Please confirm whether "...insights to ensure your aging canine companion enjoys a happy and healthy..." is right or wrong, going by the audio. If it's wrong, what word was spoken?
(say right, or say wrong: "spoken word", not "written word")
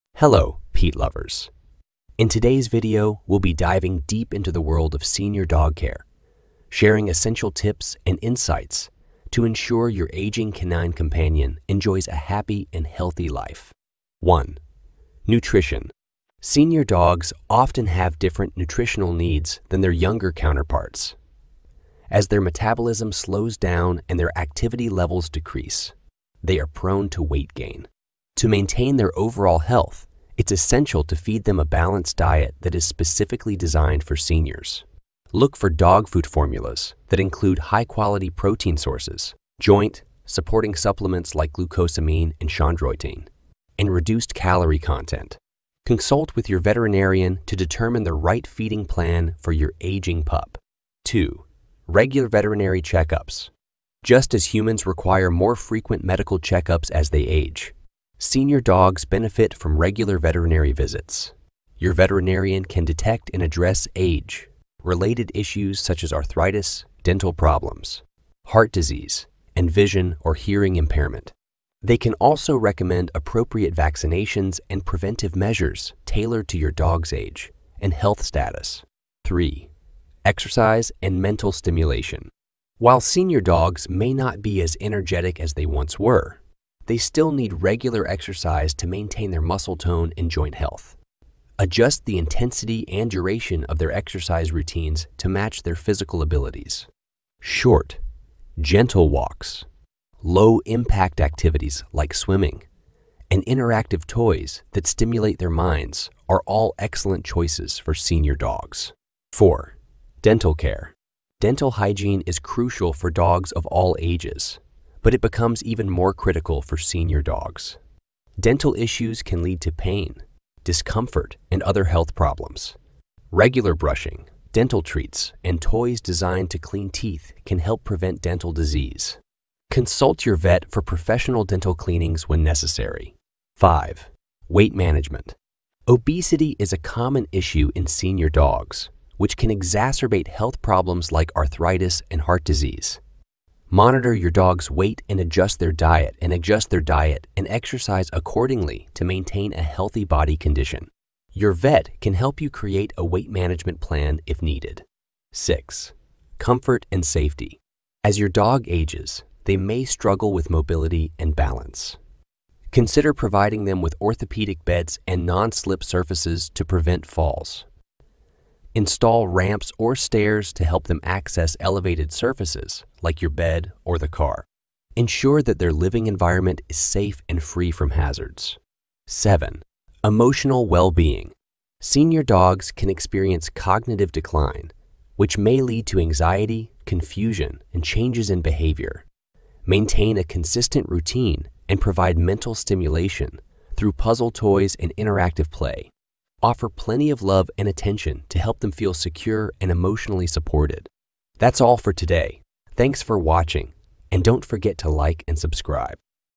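right.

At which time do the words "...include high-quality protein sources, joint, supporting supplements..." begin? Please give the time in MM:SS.
00:37.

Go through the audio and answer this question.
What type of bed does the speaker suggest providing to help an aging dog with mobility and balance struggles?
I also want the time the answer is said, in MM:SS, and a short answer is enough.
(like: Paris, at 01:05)
orthopedic beds, at 02:44.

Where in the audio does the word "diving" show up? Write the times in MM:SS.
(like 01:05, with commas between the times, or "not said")
00:03.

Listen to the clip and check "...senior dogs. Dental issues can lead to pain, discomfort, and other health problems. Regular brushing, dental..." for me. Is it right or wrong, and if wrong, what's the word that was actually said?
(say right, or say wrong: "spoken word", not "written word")
right.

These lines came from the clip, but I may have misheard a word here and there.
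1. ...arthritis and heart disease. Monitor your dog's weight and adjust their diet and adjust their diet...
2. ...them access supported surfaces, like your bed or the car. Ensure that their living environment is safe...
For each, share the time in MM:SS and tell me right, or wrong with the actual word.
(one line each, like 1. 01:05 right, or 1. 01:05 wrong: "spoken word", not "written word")
1. 02:21 right
2. 02:50 wrong: "elevated", not "supported".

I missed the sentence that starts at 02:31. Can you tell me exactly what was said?
Your vet can help you create a weight management plan if needed.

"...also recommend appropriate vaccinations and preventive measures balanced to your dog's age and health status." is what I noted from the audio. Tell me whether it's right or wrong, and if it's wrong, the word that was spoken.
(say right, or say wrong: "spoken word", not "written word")
wrong: "tailored", not "balanced".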